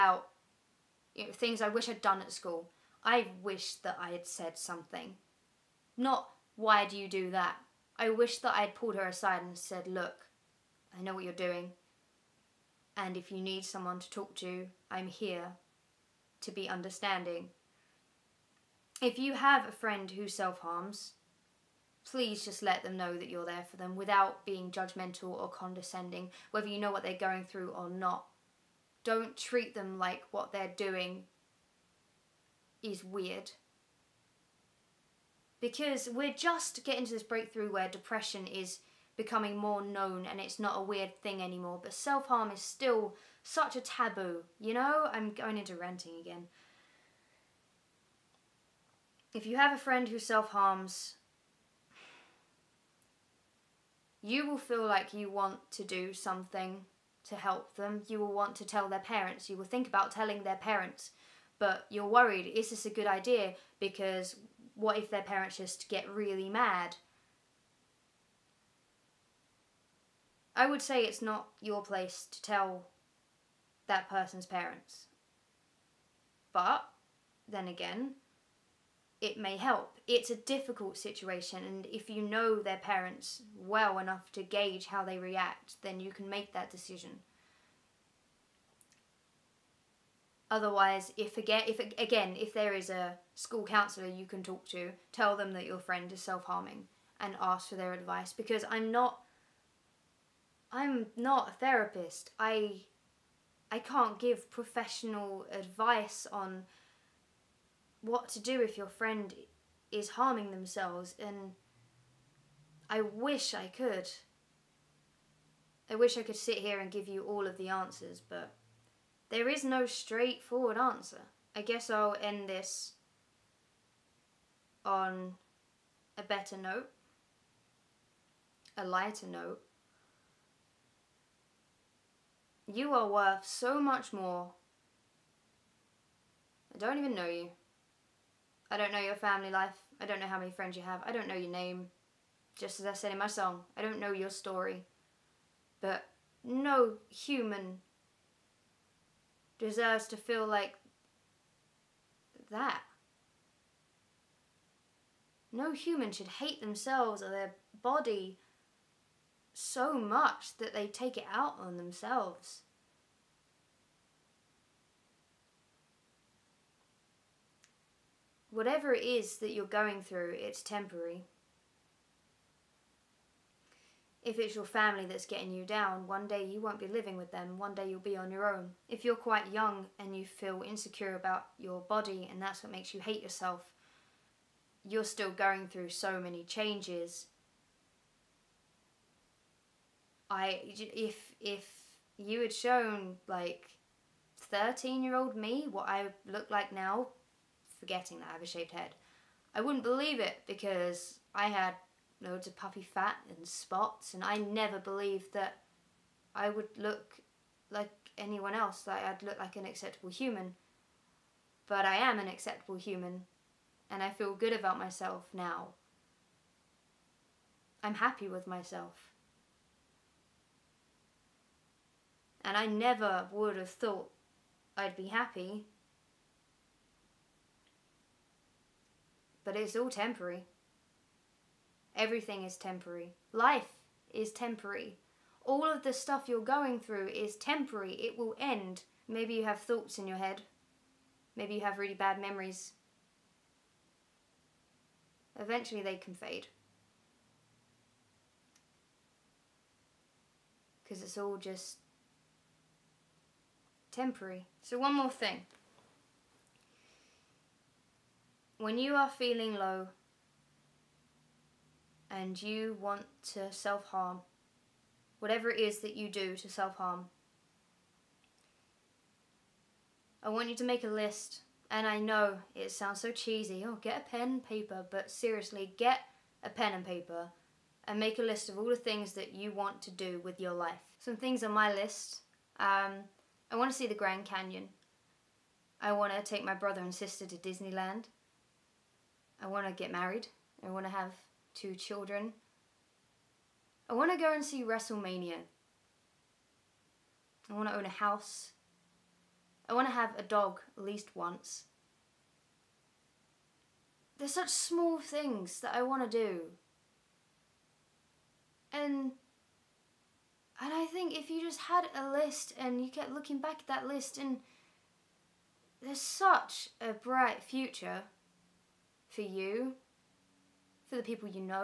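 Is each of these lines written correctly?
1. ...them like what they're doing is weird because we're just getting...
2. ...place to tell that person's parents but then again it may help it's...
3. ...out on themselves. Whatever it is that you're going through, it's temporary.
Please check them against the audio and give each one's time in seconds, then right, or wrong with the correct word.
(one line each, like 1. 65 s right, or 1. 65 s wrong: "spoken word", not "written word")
1. 29 s right
2. 71 s right
3. 161 s right.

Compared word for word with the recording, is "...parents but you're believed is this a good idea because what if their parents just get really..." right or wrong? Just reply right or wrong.
wrong.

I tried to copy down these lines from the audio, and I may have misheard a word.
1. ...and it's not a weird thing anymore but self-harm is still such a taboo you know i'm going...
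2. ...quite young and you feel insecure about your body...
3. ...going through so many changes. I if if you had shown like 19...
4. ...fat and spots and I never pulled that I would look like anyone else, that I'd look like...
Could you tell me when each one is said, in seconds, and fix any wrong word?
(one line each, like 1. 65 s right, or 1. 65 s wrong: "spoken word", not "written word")
1. 40 s right
2. 179 s right
3. 185 s wrong: "13", not "19"
4. 202 s wrong: "believed", not "pulled".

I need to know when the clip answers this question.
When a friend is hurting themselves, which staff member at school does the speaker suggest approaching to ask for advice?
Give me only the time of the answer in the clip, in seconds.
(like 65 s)
93 s.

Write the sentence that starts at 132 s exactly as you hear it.
You are worth so much more.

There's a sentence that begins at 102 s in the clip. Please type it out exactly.
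I I can't give professional advice on what to do if your friend is harming themselves and I wish I could.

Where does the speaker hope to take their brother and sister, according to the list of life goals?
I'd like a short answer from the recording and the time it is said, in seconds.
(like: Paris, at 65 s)
Disneyland, at 287 s.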